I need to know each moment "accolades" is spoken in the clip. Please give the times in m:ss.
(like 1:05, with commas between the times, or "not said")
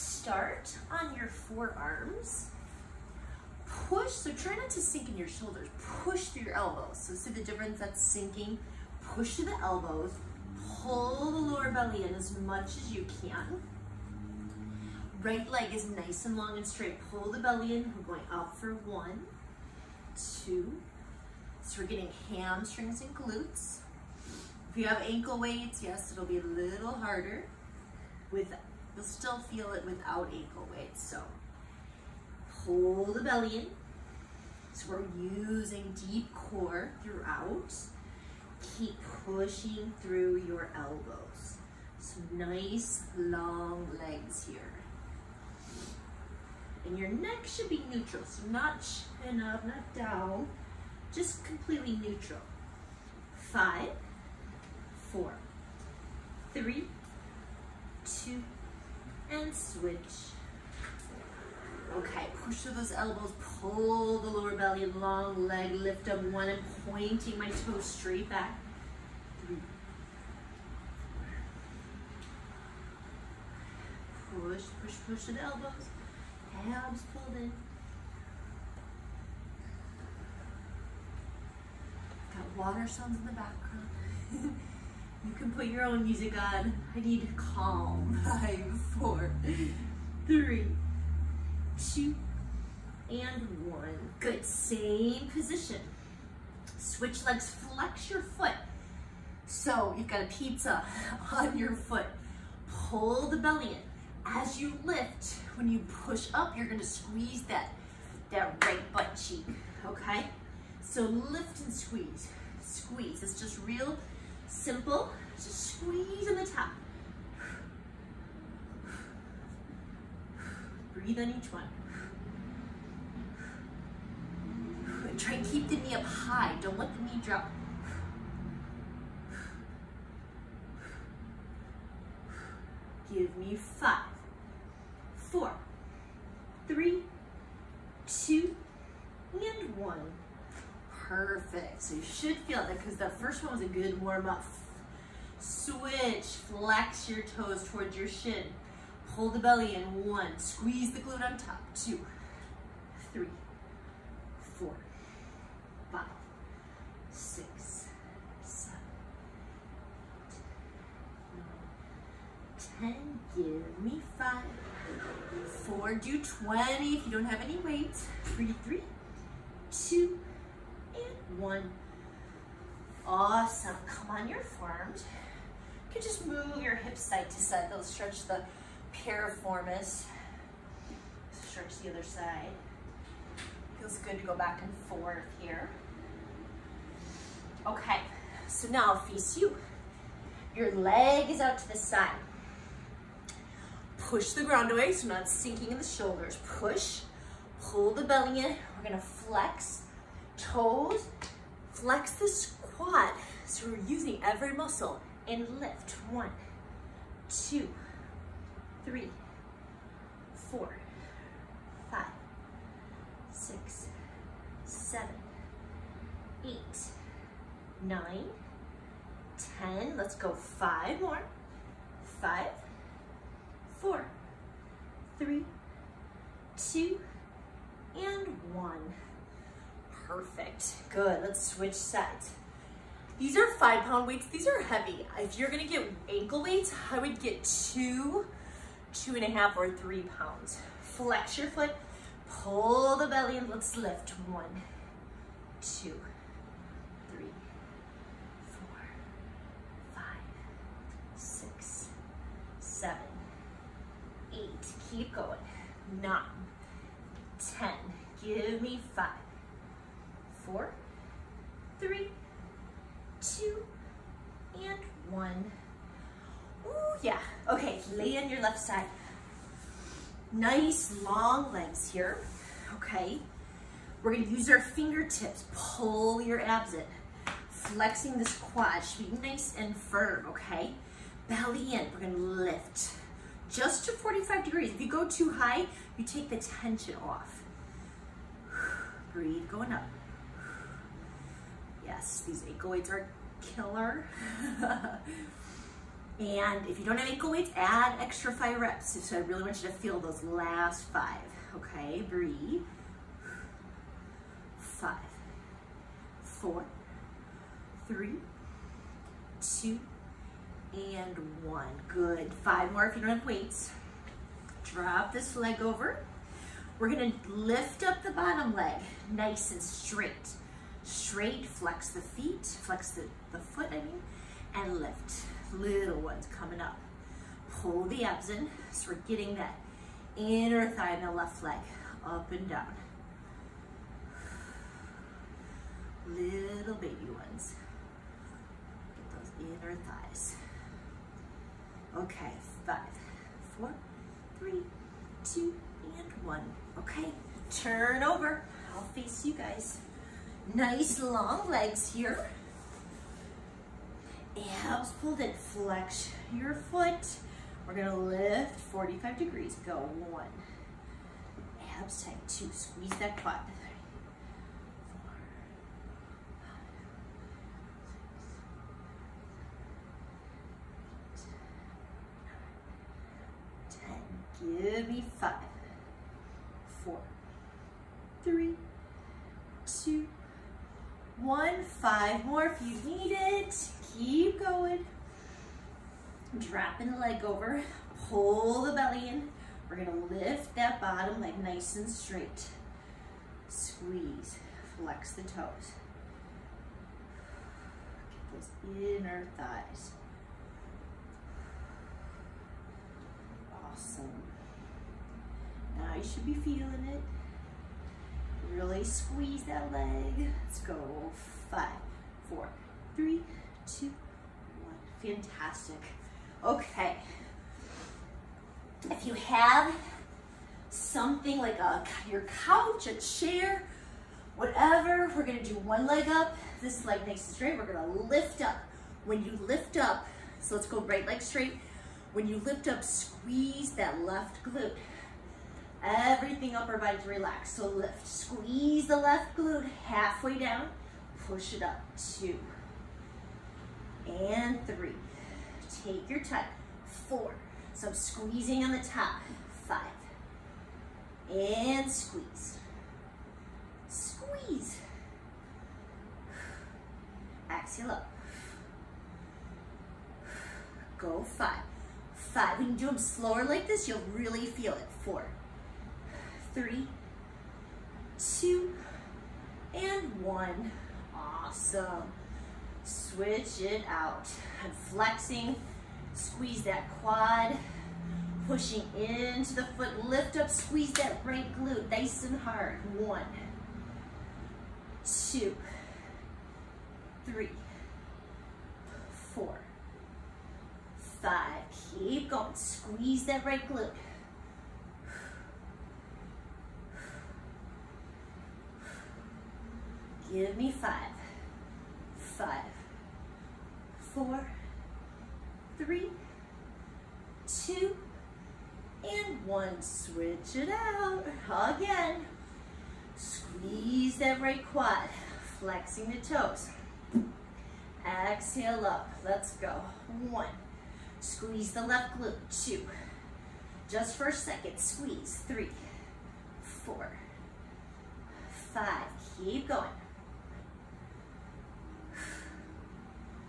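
not said.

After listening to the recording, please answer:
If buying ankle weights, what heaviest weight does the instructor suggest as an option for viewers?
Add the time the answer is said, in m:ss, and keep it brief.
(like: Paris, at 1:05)
3 pounds, at 3:59.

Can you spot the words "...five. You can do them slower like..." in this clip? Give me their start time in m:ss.
7:42.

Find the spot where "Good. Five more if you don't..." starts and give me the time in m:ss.
5:11.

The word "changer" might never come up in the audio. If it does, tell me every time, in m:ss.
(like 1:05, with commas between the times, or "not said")
not said.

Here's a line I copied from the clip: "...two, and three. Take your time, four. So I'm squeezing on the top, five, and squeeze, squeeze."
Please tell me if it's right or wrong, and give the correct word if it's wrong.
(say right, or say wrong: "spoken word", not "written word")
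right.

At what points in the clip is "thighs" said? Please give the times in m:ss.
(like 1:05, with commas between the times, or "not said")
5:30, 5:39, 6:39.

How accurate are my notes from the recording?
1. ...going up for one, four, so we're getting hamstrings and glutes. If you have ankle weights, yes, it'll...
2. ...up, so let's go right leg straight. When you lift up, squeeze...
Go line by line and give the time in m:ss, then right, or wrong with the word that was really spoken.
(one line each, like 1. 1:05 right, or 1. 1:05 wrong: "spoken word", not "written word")
1. 0:18 wrong: "two", not "four"
2. 7:09 right.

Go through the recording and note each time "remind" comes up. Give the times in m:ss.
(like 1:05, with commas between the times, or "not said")
not said.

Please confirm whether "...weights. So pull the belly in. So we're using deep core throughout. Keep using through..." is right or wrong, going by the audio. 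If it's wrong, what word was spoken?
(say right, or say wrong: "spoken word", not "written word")
wrong: "pushing", not "using".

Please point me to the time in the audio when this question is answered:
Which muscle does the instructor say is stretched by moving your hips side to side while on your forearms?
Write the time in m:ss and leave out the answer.
2:58.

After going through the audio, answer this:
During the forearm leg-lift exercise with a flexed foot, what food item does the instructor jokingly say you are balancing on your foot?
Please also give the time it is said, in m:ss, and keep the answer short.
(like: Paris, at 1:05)
pizza, at 1:40.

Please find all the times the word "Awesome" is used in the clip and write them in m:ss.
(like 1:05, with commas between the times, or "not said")
2:53, 6:43, 7:51.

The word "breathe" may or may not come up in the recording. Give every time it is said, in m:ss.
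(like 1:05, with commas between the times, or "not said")
2:00, 4:49, 5:02.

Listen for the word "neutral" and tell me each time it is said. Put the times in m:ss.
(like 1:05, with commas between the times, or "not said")
0:47, 0:52.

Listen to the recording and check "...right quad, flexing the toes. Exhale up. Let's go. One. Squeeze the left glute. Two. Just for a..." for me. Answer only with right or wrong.
right.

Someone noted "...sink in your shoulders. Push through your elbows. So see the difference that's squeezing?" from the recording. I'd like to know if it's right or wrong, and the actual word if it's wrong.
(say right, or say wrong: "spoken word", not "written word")
wrong: "sinking", not "squeezing".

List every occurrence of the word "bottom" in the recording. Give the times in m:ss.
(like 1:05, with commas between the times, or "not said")
5:18, 6:30.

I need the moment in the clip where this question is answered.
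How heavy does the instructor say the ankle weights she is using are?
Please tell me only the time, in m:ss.
3:53.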